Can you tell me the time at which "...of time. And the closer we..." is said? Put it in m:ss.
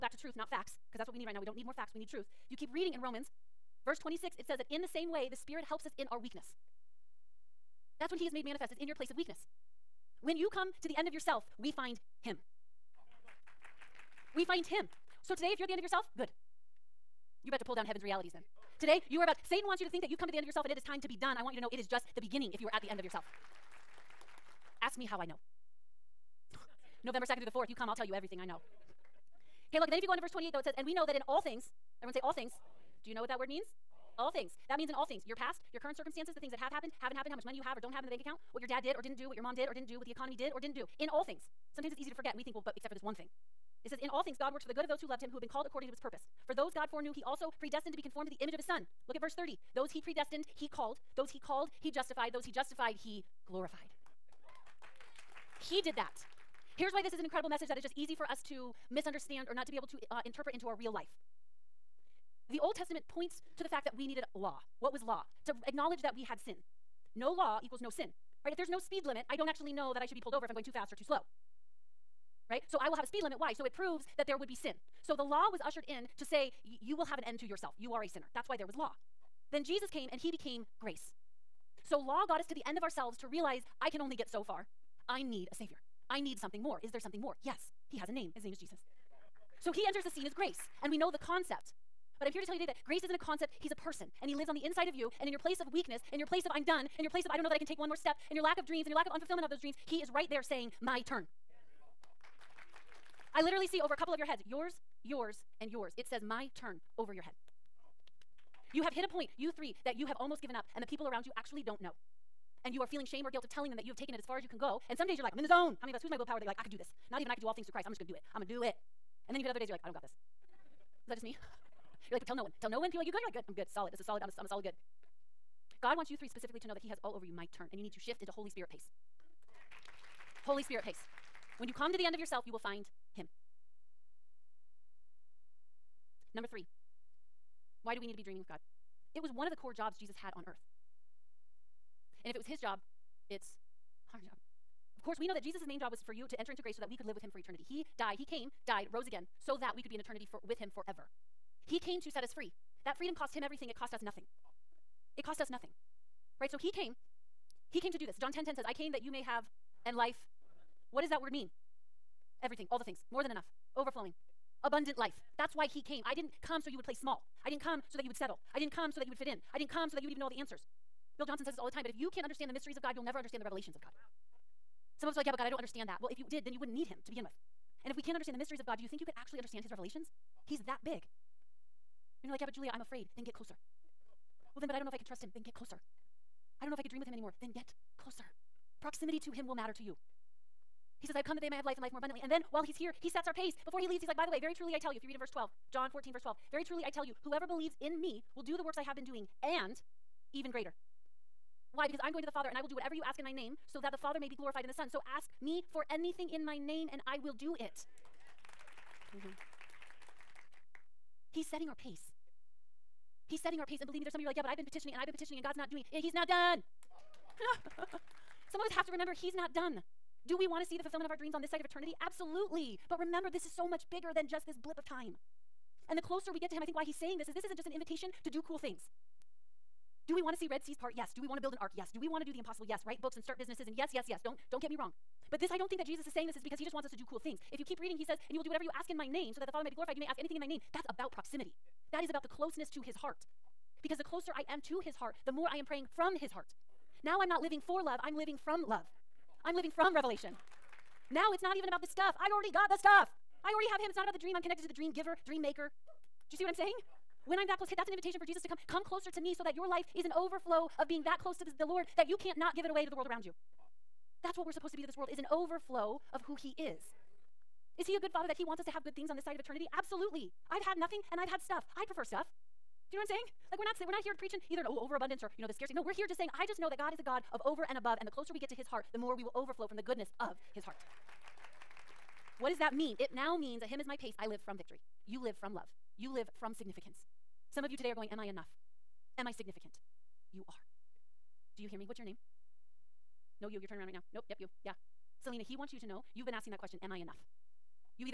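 3:44.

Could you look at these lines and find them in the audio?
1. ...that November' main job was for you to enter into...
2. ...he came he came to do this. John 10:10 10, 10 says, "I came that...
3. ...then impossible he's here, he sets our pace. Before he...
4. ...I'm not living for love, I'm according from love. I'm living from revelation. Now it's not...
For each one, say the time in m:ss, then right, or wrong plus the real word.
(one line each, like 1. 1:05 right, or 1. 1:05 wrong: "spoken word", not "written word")
1. 2:25 wrong: "Jesus", not "November"
2. 2:36 right
3. 3:12 wrong: "while", not "impossible"
4. 4:07 wrong: "living", not "according".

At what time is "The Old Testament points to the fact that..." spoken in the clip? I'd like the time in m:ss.
1:02.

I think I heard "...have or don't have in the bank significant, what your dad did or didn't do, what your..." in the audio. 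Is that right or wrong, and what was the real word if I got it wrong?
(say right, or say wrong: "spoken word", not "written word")
wrong: "account", not "significant".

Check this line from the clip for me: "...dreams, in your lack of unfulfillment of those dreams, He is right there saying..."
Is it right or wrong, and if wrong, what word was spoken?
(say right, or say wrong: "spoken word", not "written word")
right.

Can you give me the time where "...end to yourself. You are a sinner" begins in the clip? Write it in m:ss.
1:17.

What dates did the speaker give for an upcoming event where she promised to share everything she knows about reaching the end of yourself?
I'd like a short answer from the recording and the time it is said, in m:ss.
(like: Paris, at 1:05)
November 2nd through 4th, at 0:27.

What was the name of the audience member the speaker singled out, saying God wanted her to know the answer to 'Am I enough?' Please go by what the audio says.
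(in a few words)
Selena.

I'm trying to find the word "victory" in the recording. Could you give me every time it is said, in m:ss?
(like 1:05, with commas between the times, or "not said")
4:44.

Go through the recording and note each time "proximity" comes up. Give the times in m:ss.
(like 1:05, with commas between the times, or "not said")
3:08, 4:01.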